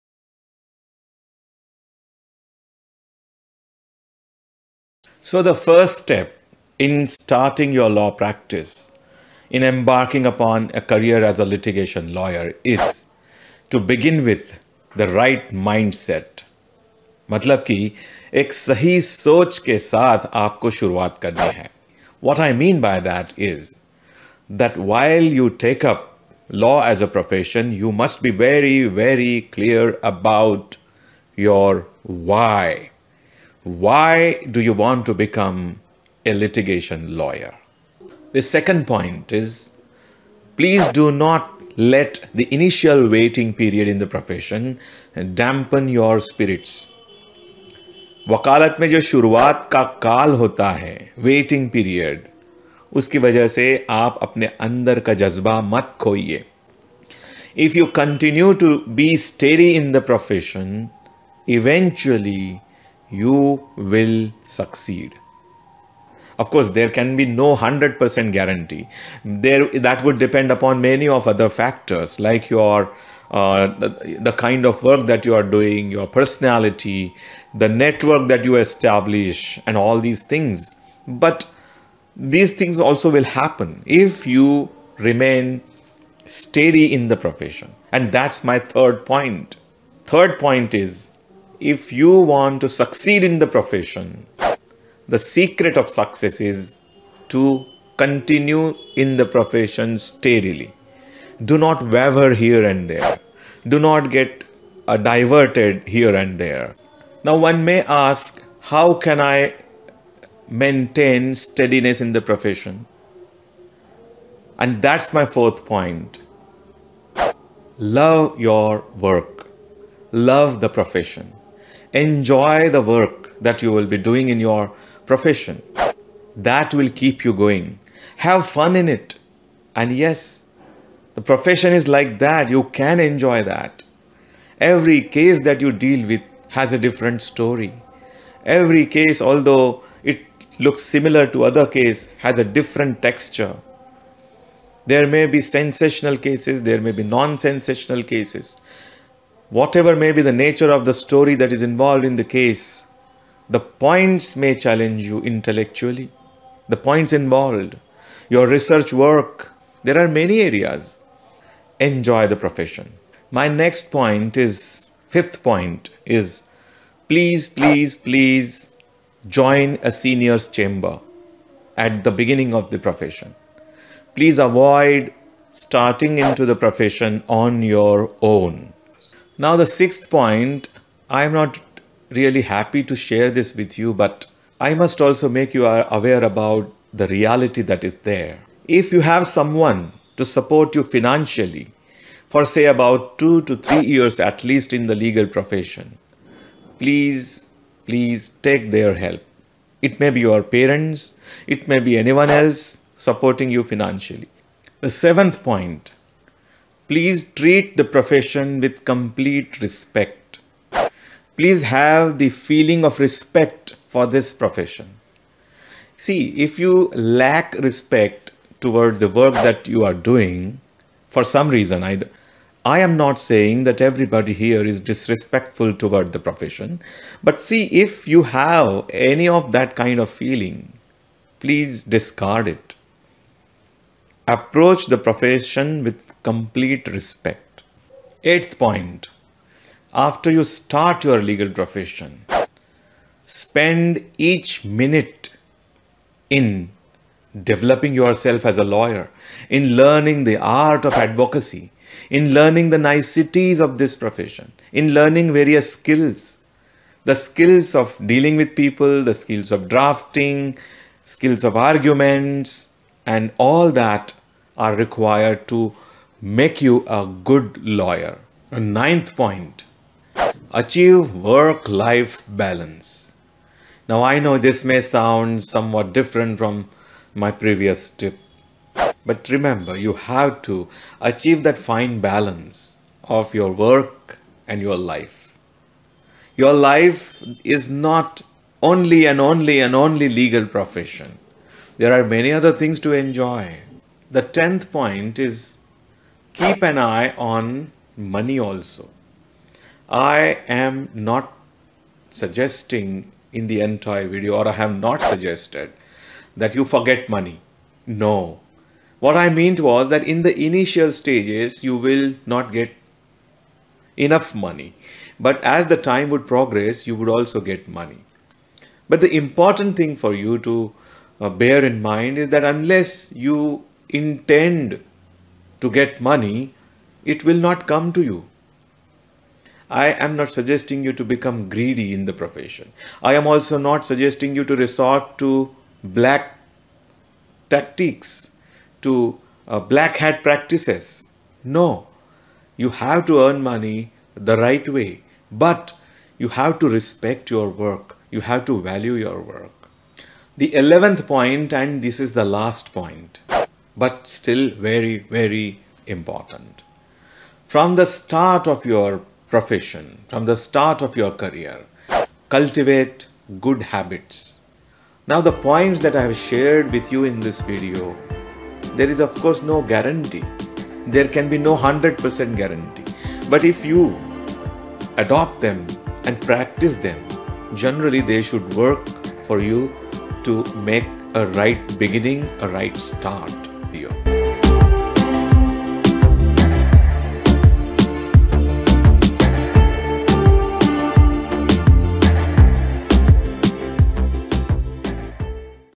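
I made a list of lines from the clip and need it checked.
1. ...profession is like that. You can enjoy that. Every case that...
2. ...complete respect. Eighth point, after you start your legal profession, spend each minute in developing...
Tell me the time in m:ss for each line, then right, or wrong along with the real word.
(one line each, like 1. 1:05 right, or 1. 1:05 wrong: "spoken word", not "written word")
1. 2:11 right
2. 3:56 right.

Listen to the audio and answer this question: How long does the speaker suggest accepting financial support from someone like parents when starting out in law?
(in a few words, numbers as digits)
2 to 3 years.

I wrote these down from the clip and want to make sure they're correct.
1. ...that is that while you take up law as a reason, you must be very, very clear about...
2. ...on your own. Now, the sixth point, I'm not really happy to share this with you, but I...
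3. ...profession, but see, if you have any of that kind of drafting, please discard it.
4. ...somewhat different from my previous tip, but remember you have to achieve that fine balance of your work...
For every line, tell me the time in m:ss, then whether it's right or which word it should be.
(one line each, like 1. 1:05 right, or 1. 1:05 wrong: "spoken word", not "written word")
1. 0:23 wrong: "profession", not "reason"
2. 2:57 right
3. 3:46 wrong: "feeling", not "drafting"
4. 4:35 right.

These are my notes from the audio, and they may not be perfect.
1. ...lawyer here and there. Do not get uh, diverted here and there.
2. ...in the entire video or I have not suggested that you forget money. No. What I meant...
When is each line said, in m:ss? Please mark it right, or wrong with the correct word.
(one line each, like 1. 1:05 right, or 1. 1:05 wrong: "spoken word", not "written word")
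1. 1:41 wrong: "waver", not "lawyer"
2. 5:03 right.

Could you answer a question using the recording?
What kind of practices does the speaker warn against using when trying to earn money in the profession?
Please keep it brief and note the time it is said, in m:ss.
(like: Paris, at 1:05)
Black hat practices, at 5:39.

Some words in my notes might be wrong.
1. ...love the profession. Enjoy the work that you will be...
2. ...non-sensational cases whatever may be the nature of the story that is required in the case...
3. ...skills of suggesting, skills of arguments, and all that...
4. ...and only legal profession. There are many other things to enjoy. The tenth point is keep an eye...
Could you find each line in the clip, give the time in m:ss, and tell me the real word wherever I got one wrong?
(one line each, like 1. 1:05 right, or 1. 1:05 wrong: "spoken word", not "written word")
1. 2:00 right
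2. 2:27 wrong: "involved", not "required"
3. 4:19 wrong: "drafting", not "suggesting"
4. 4:49 right.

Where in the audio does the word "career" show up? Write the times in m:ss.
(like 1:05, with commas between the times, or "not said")
0:10, 6:01.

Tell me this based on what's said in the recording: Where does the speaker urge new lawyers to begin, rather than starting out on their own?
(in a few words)
A senior's chamber.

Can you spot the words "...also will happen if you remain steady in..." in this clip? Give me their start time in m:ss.
1:22.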